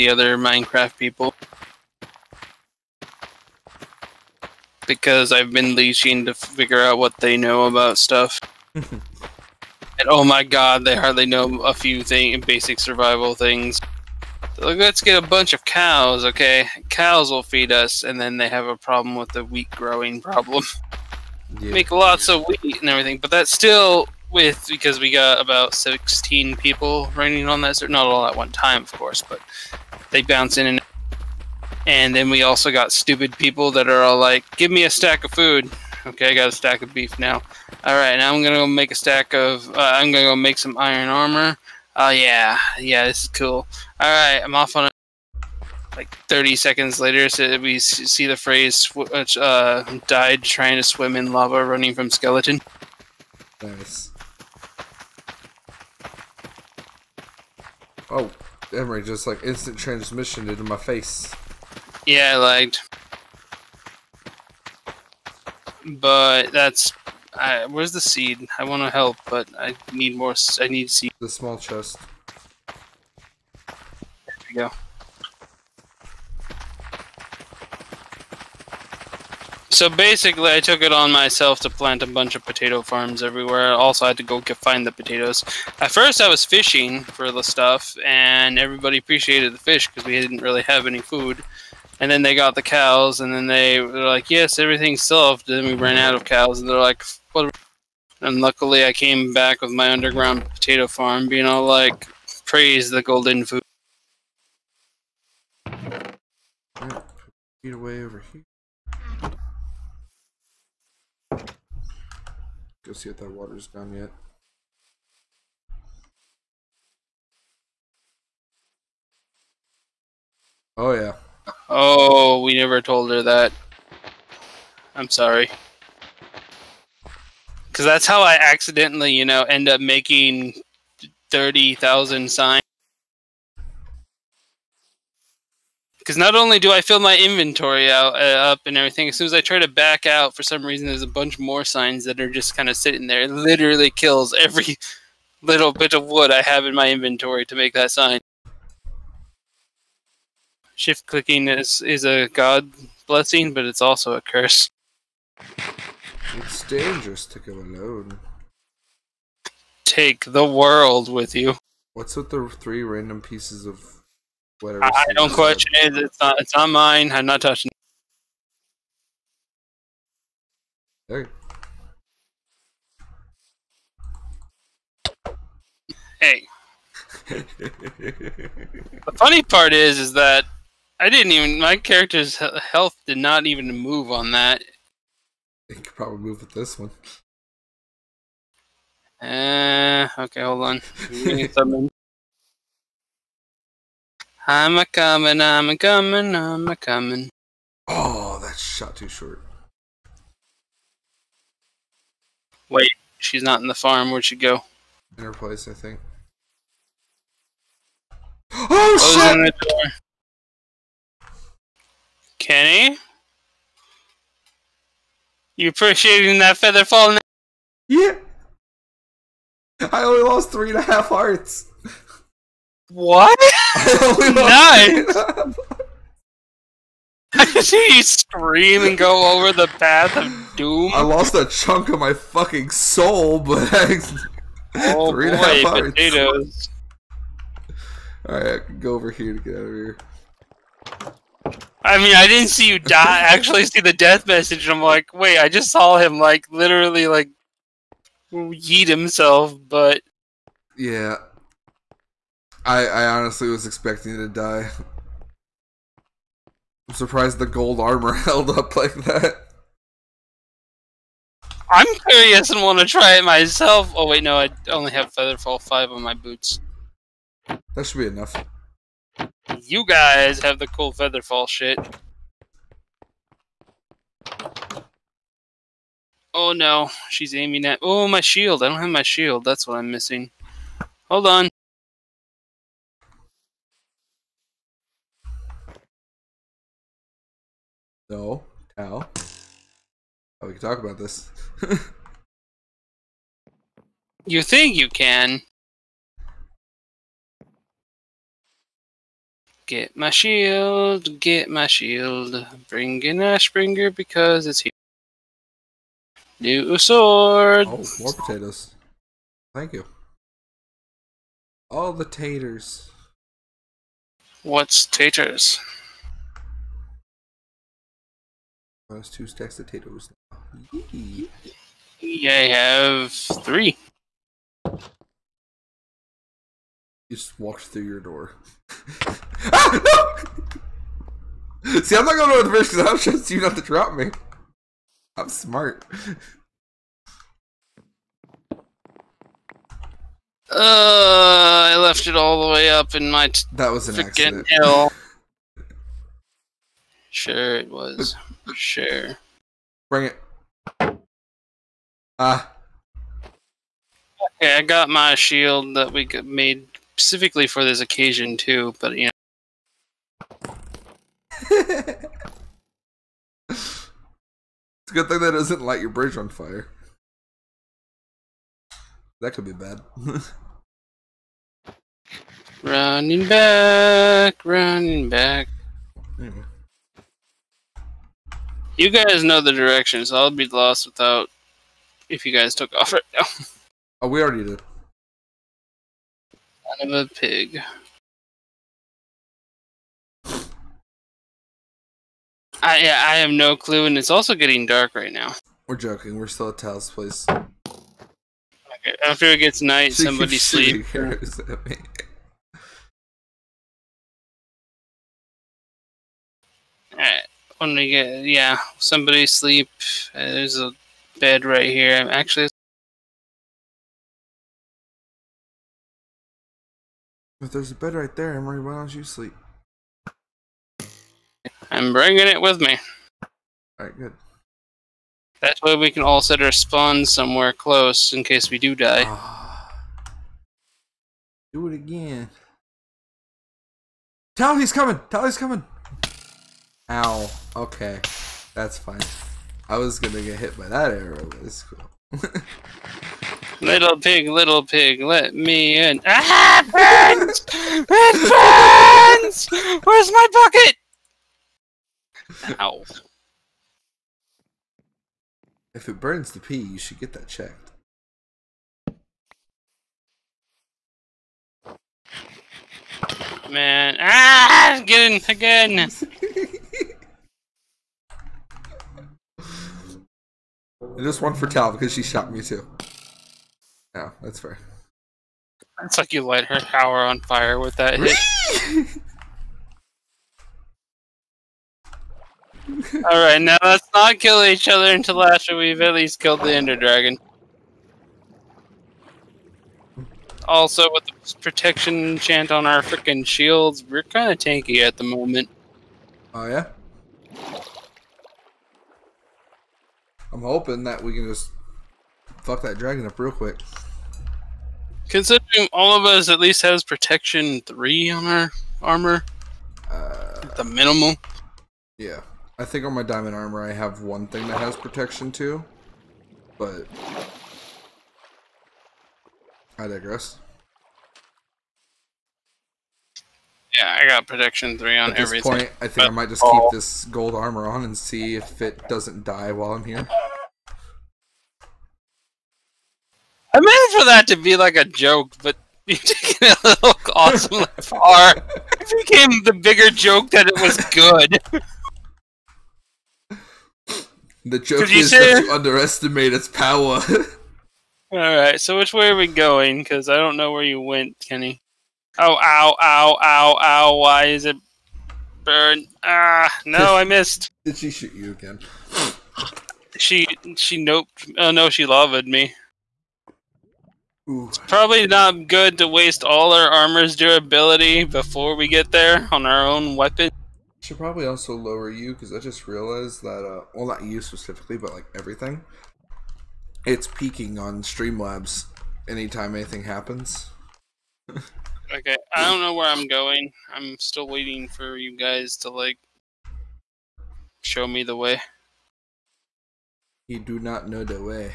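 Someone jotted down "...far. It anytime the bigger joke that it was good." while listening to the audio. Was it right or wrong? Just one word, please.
wrong.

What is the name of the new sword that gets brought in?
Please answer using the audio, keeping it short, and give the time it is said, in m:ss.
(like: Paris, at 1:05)
Ashbringer, at 5:03.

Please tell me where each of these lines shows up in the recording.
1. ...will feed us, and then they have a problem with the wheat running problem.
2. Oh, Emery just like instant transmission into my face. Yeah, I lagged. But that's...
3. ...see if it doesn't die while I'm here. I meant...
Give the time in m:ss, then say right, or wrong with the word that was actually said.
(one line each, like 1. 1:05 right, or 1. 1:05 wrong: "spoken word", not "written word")
1. 0:17 wrong: "growing", not "running"
2. 0:58 right
3. 8:47 right.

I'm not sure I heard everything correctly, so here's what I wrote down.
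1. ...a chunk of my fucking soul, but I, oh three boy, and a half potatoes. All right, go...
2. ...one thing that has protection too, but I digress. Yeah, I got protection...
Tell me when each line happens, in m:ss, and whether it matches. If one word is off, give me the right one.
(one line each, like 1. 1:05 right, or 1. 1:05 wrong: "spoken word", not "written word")
1. 3:51 right
2. 8:34 right.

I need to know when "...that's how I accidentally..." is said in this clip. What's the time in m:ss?
2:07.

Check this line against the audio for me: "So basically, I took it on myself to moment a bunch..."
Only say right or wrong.
wrong.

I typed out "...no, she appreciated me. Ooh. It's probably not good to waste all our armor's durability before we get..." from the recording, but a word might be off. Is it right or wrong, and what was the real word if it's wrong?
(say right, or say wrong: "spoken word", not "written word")
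wrong: "loved", not "appreciated".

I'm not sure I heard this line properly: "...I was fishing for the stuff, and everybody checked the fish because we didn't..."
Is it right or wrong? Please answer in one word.
wrong.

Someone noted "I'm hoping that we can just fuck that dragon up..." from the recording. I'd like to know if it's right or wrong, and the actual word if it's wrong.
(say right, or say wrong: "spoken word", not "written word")
right.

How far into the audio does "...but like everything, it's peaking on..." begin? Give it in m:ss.
9:34.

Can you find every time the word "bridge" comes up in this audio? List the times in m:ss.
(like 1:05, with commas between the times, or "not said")
5:32, 6:05.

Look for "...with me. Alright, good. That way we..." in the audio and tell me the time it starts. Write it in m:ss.
7:02.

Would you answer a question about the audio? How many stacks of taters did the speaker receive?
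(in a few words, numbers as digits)
2.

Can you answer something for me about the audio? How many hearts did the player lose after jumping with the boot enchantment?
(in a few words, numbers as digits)
3 and a half.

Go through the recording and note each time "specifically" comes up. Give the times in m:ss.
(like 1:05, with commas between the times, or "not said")
5:56, 9:34.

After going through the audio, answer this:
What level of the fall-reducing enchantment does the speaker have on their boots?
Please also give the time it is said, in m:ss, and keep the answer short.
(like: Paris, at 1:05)
Featherfall 5, at 4:25.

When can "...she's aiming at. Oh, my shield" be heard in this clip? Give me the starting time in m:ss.
4:37.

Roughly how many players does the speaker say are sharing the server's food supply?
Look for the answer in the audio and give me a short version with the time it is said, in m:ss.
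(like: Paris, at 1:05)
16, at 0:25.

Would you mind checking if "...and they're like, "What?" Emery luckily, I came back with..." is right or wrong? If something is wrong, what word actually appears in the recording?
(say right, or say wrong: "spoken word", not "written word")
wrong: "And", not "Emery".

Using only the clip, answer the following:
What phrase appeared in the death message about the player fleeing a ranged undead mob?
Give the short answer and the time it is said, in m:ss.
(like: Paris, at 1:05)
died trying to swim in lava, at 0:50.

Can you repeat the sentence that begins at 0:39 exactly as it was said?
Uh, I'm gonna go make some iron armor.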